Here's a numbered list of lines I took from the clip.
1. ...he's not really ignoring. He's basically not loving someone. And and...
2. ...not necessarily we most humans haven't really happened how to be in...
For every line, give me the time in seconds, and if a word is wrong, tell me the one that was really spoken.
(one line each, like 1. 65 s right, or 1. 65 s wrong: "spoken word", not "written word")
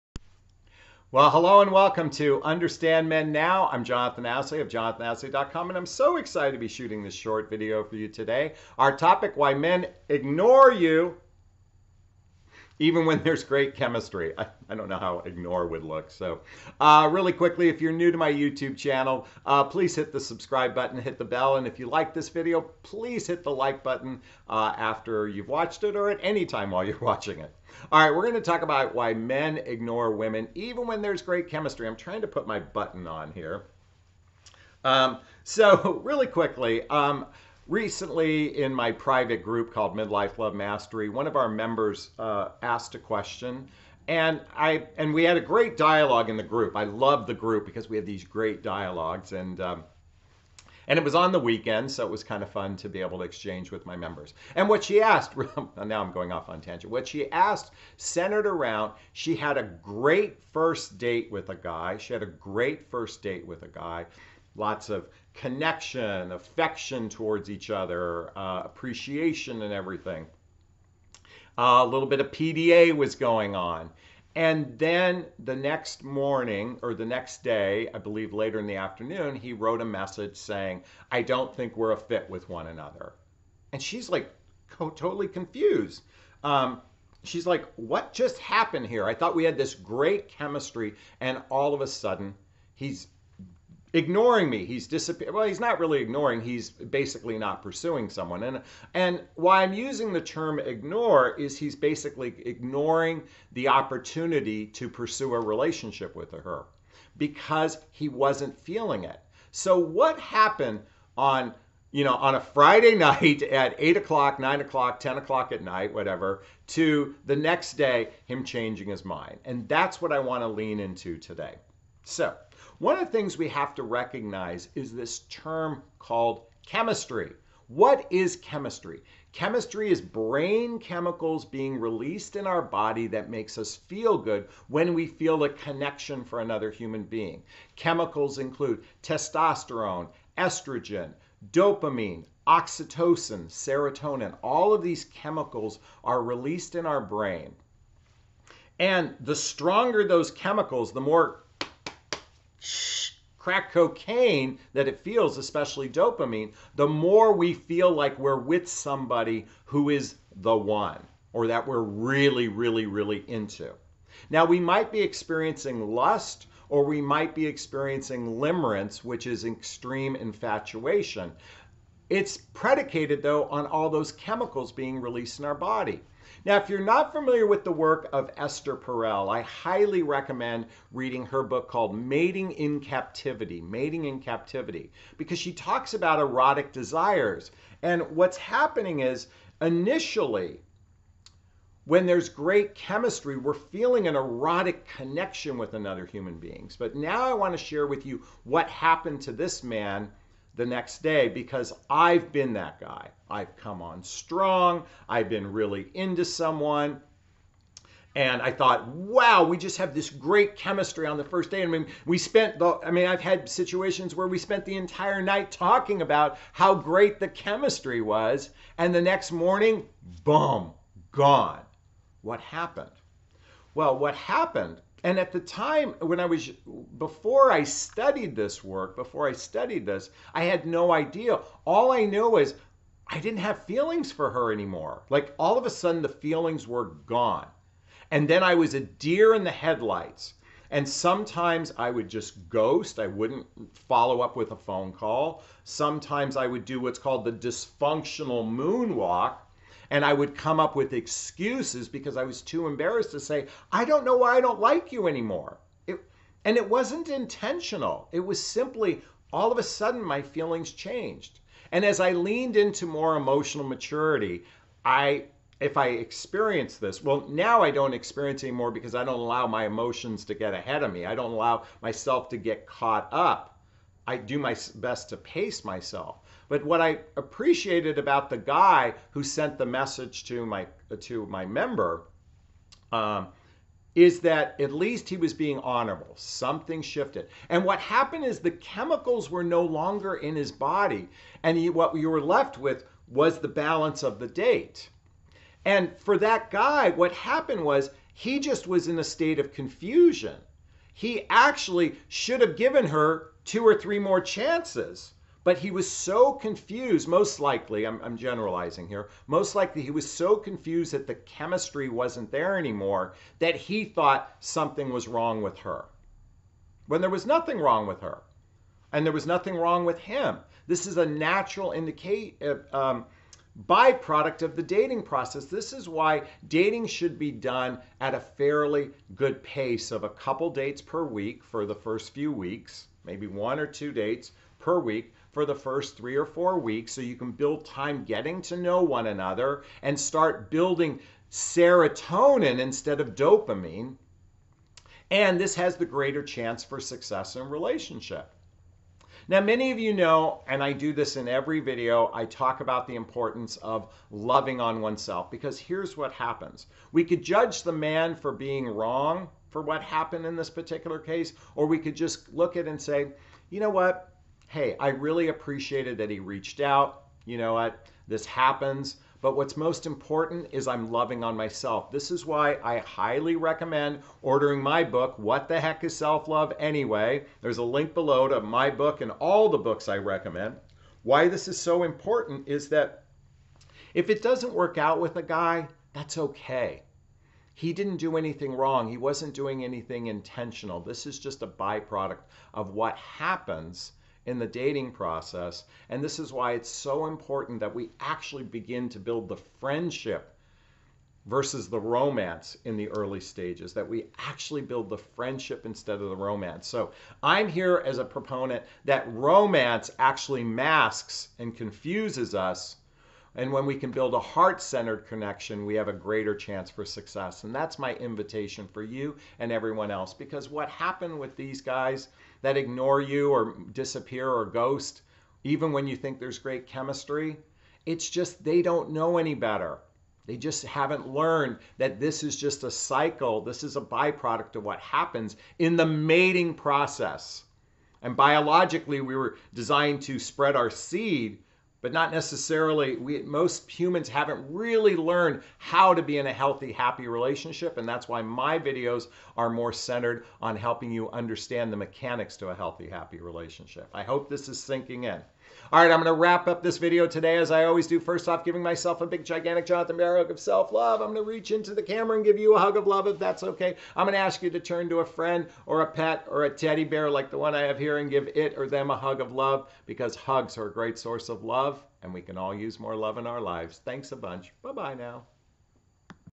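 1. 95 s wrong: "pursuing", not "loving"
2. 441 s wrong: "learned", not "happened".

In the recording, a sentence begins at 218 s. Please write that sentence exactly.
And the next morning, boom, gone.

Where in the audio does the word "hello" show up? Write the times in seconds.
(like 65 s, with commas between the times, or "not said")
1 s.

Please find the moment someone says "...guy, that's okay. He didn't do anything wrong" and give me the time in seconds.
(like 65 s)
385 s.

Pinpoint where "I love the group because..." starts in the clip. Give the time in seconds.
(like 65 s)
46 s.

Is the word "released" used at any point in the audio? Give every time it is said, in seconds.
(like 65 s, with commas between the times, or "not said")
131 s, 146 s, 175 s.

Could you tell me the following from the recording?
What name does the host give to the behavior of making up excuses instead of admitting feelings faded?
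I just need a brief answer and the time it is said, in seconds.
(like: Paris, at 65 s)
dysfunctional moonwalk, at 247 s.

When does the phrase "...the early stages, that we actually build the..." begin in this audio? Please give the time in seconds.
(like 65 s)
402 s.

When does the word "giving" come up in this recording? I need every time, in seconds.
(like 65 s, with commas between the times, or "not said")
458 s.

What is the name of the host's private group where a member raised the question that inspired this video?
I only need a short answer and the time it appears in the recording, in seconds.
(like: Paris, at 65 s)
Midlife Love Mastery, at 39 s.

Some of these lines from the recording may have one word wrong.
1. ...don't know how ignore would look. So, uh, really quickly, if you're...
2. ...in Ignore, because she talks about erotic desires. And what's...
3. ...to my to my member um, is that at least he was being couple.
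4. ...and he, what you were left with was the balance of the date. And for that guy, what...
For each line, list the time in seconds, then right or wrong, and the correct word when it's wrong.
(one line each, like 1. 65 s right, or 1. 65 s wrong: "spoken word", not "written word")
1. 14 s right
2. 184 s wrong: "Captivity", not "Ignore"
3. 280 s wrong: "honorable", not "couple"
4. 291 s right.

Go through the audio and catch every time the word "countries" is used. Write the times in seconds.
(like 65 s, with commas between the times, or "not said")
not said.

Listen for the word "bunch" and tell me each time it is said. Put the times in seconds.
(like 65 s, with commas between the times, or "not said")
474 s.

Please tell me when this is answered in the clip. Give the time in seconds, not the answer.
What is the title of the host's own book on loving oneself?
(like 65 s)
375 s.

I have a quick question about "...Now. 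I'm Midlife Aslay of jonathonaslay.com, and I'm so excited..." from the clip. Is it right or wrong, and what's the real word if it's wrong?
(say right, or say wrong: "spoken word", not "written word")
wrong: "Jonathon", not "Midlife".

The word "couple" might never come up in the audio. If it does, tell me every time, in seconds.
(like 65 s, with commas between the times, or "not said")
330 s.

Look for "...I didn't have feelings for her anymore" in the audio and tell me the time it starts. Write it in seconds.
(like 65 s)
233 s.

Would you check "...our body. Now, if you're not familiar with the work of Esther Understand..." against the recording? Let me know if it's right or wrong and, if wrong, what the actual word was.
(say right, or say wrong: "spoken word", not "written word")
wrong: "Perel", not "Understand".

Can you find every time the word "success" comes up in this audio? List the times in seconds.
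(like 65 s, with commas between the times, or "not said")
346 s, 416 s.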